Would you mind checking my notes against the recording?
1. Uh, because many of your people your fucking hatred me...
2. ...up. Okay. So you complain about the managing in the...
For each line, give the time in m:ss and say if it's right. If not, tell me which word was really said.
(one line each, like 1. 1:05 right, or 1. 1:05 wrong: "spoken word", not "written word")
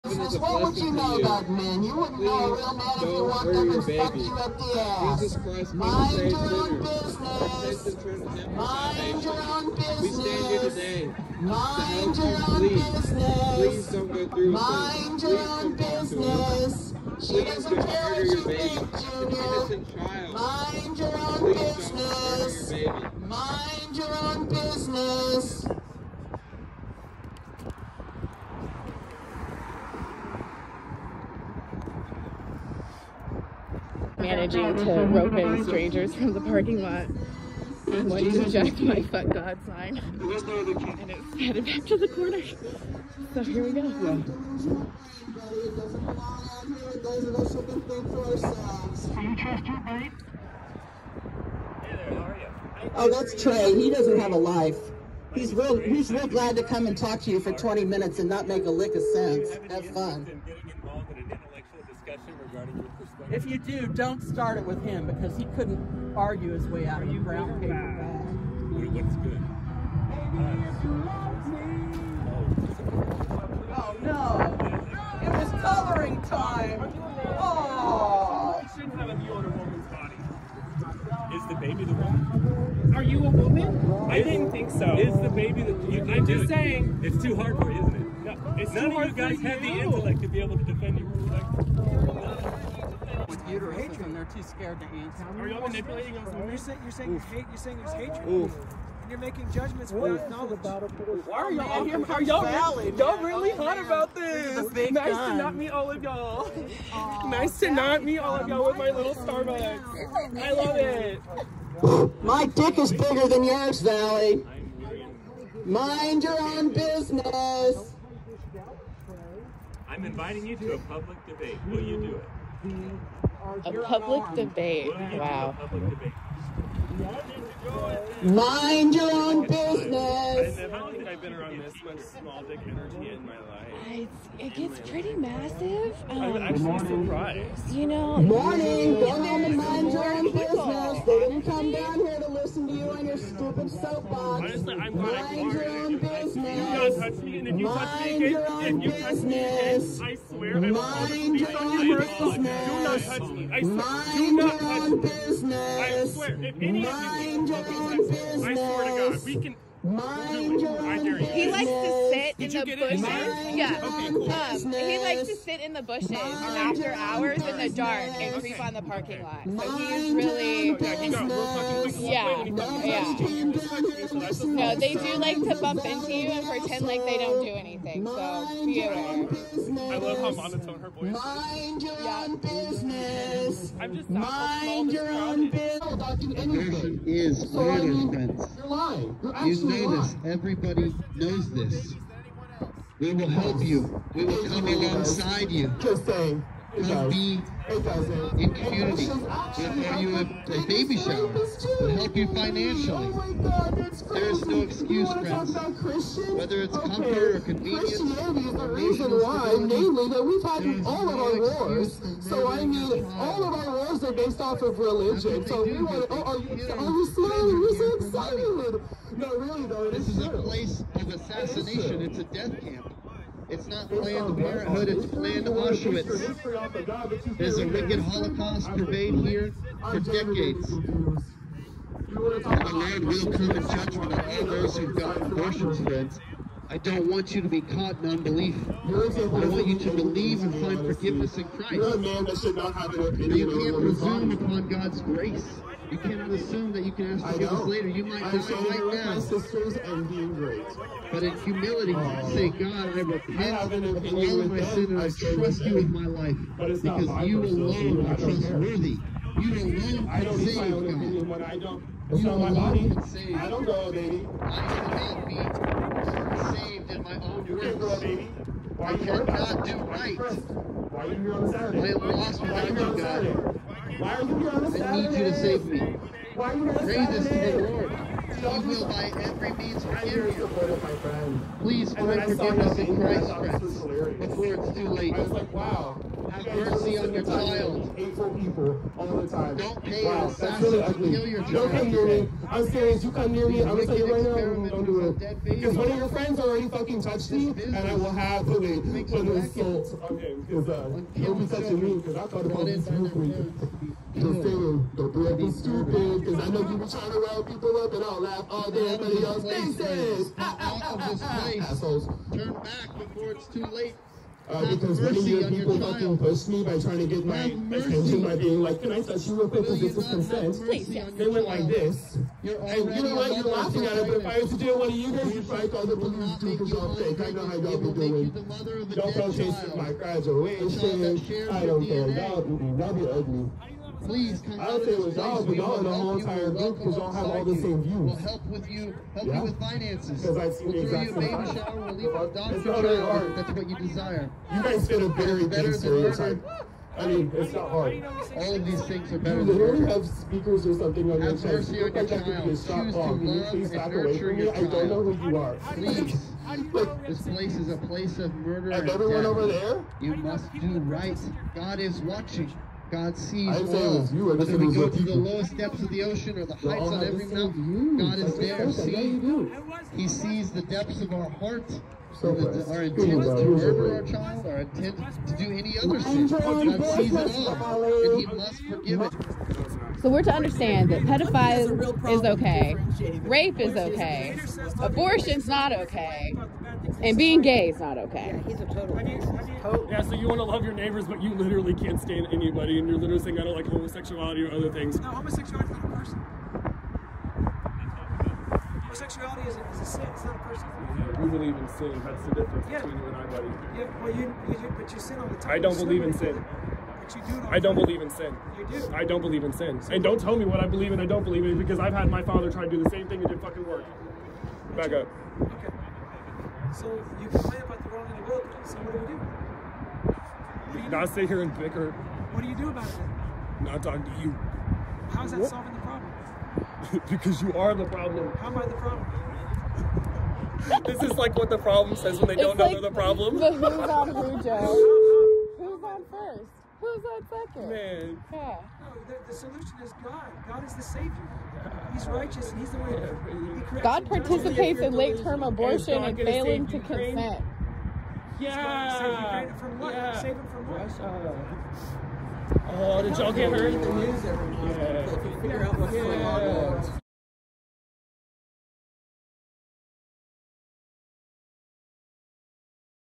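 1. 5:14 wrong: "pushed", not "hatred"
2. 6:54 wrong: "wrong", not "managing".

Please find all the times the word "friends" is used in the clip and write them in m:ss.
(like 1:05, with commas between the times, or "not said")
3:25, 3:55, 4:43, 4:56.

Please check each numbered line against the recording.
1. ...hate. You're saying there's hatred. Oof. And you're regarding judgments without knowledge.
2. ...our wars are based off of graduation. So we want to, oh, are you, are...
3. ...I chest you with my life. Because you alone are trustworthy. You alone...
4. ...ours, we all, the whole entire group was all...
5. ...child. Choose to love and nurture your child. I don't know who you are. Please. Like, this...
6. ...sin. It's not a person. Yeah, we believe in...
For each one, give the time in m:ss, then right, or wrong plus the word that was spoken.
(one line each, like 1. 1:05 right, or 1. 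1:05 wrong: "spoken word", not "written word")
1. 1:37 wrong: "making", not "regarding"
2. 3:33 wrong: "religion", not "graduation"
3. 4:15 wrong: "trust", not "chest"
4. 5:35 right
5. 5:52 right
6. 6:39 right.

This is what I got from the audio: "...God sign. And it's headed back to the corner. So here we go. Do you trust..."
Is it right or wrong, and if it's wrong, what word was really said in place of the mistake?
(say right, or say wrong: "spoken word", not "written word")
right.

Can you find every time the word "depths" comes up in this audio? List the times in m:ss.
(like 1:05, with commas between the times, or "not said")
6:05, 6:10.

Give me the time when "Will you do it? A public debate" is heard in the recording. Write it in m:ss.
2:01.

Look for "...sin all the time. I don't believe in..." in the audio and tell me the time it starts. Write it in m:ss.
6:44.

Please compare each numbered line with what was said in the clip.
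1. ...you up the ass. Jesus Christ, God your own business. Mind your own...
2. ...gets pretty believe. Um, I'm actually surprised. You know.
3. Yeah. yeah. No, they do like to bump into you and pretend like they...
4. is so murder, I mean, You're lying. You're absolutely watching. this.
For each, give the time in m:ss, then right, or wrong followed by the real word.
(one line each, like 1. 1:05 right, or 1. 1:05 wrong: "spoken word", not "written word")
1. 0:04 wrong: "Mind", not "God"
2. 2:14 wrong: "massive", not "believe"
3. 2:52 right
4. 3:07 wrong: "lying", not "watching".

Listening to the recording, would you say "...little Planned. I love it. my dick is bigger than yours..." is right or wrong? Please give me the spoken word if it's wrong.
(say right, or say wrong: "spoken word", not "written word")
wrong: "Starbucks", not "Planned".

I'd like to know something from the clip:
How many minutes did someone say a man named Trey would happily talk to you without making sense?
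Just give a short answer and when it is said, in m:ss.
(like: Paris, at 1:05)
20, at 0:57.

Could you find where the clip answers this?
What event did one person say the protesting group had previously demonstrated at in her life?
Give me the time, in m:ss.
5:29.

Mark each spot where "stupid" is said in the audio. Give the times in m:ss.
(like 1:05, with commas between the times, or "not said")
2:23, 5:05.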